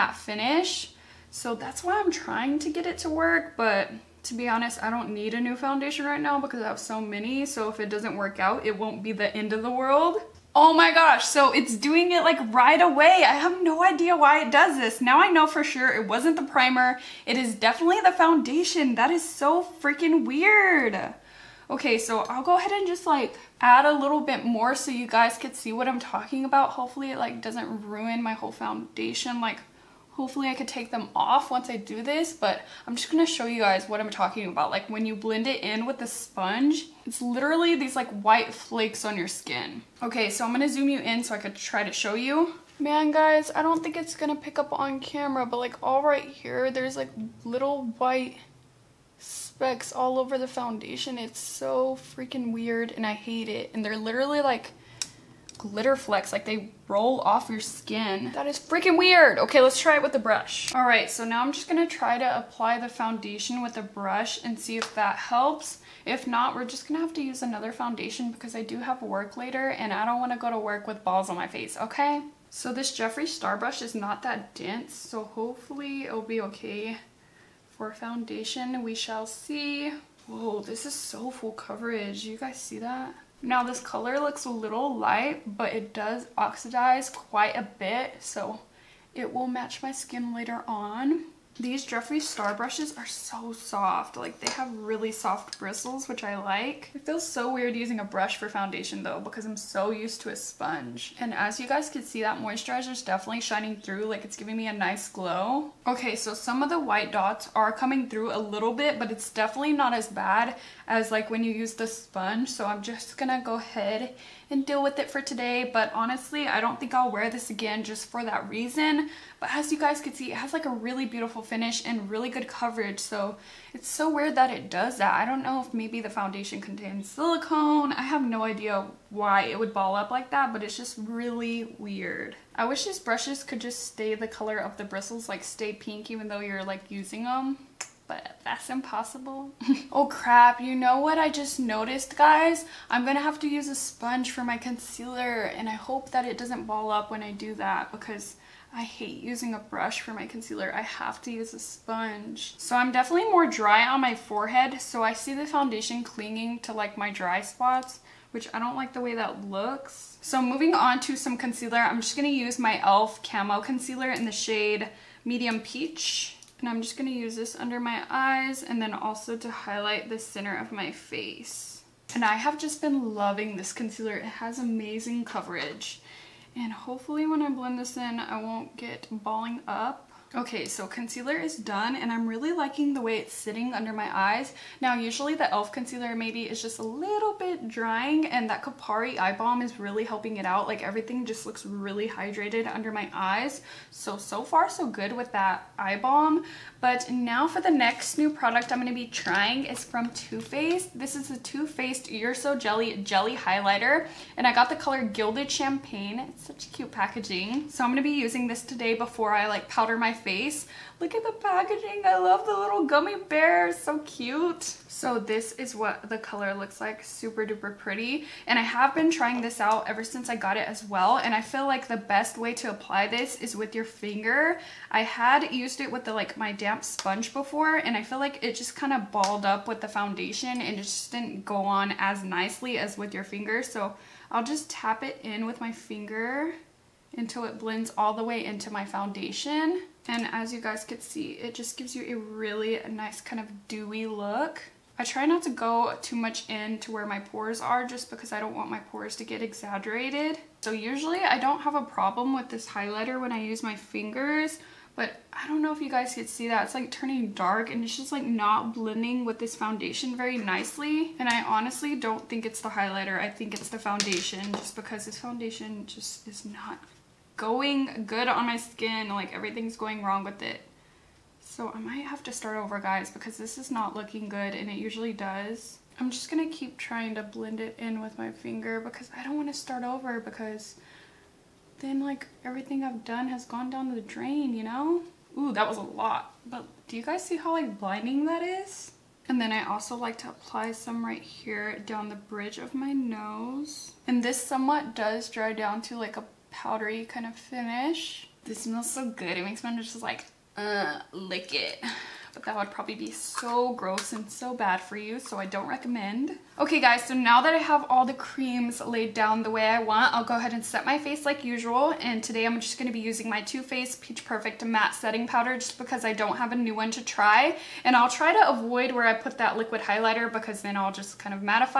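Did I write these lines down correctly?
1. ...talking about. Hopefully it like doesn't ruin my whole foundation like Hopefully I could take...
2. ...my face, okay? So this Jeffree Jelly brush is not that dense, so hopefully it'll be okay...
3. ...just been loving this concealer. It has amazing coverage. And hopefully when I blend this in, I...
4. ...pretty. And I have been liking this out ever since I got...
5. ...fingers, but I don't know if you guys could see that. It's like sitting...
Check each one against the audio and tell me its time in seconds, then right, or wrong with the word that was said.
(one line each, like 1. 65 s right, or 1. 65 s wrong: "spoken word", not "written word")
1. 25 s right
2. 71 s wrong: "Star", not "Jelly"
3. 172 s right
4. 217 s wrong: "trying", not "liking"
5. 253 s wrong: "turning", not "sitting".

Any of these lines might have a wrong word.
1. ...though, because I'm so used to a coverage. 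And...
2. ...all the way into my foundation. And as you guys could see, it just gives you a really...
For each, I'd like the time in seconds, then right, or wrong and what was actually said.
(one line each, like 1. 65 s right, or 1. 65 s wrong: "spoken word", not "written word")
1. 99 s wrong: "sponge", not "coverage"
2. 237 s right.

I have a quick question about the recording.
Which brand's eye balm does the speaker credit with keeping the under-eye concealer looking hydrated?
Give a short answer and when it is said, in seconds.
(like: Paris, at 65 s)
Kopari, at 188 s.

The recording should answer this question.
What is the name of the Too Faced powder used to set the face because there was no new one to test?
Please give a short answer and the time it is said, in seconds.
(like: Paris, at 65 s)
Peach Perfect Matte Setting Powder, at 314 s.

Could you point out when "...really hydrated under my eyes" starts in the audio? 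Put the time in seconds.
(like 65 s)
191 s.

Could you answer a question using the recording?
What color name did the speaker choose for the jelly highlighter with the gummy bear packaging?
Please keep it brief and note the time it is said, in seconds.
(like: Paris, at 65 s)
Gilded Champagne, at 205 s.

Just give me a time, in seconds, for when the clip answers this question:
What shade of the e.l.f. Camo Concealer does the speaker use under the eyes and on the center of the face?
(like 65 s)
165 s.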